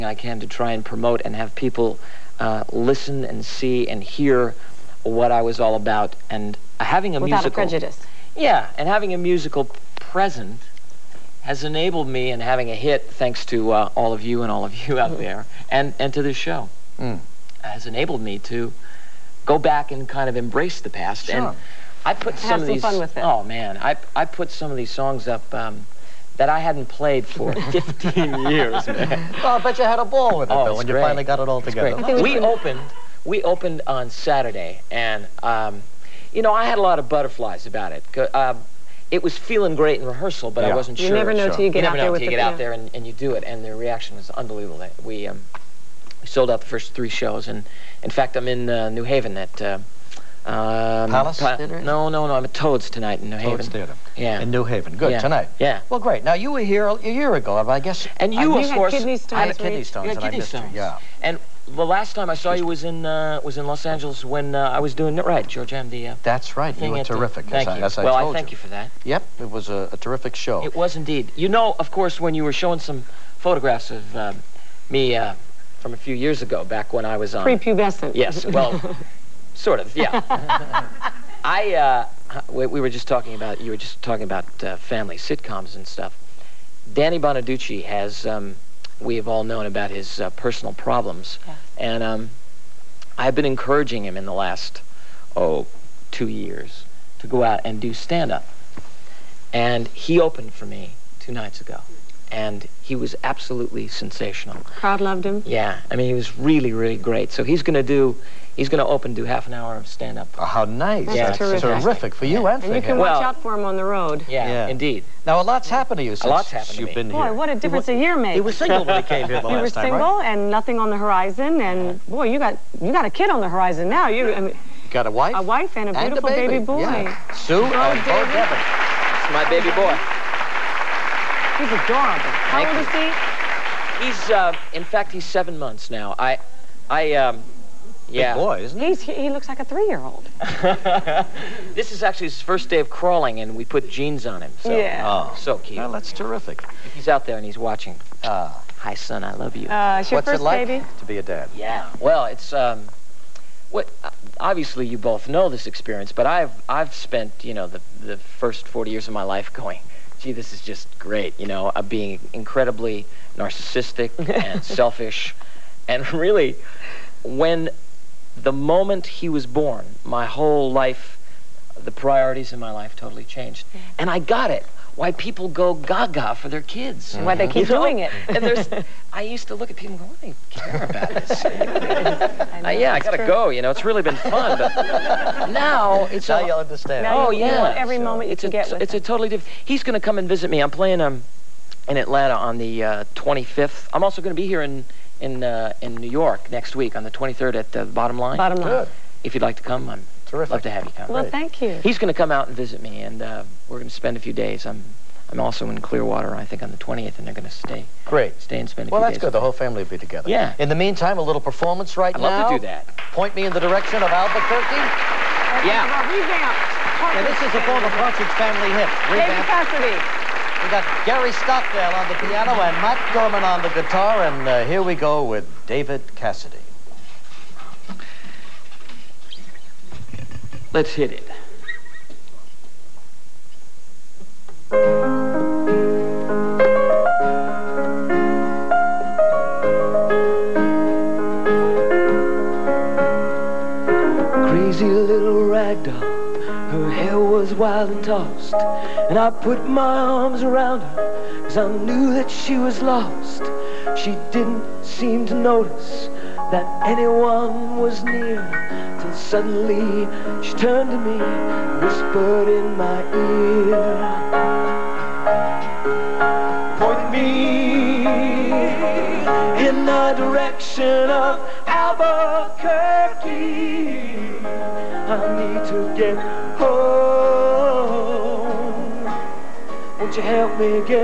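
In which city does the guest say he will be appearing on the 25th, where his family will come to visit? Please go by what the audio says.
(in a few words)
Atlanta.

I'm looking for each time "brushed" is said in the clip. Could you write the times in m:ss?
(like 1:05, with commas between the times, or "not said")
not said.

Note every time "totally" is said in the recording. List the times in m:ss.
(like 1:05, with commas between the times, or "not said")
2:52, 3:08.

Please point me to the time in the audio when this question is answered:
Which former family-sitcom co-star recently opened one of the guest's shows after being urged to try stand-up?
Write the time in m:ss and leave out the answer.
1:26.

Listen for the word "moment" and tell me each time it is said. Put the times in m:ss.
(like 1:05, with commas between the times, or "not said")
2:48, 3:08.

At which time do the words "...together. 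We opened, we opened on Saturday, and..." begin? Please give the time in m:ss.
0:31.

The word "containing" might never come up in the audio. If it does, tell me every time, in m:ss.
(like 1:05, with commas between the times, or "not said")
not said.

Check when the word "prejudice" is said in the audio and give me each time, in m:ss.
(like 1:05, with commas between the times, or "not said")
0:07.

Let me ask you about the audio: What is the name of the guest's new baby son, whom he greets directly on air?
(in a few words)
Beau Devin.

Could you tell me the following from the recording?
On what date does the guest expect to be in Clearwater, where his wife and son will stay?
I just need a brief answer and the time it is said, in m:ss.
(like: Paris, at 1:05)
20th, at 3:26.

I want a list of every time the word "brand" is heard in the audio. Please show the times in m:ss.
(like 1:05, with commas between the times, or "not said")
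not said.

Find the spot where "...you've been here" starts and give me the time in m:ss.
1:56.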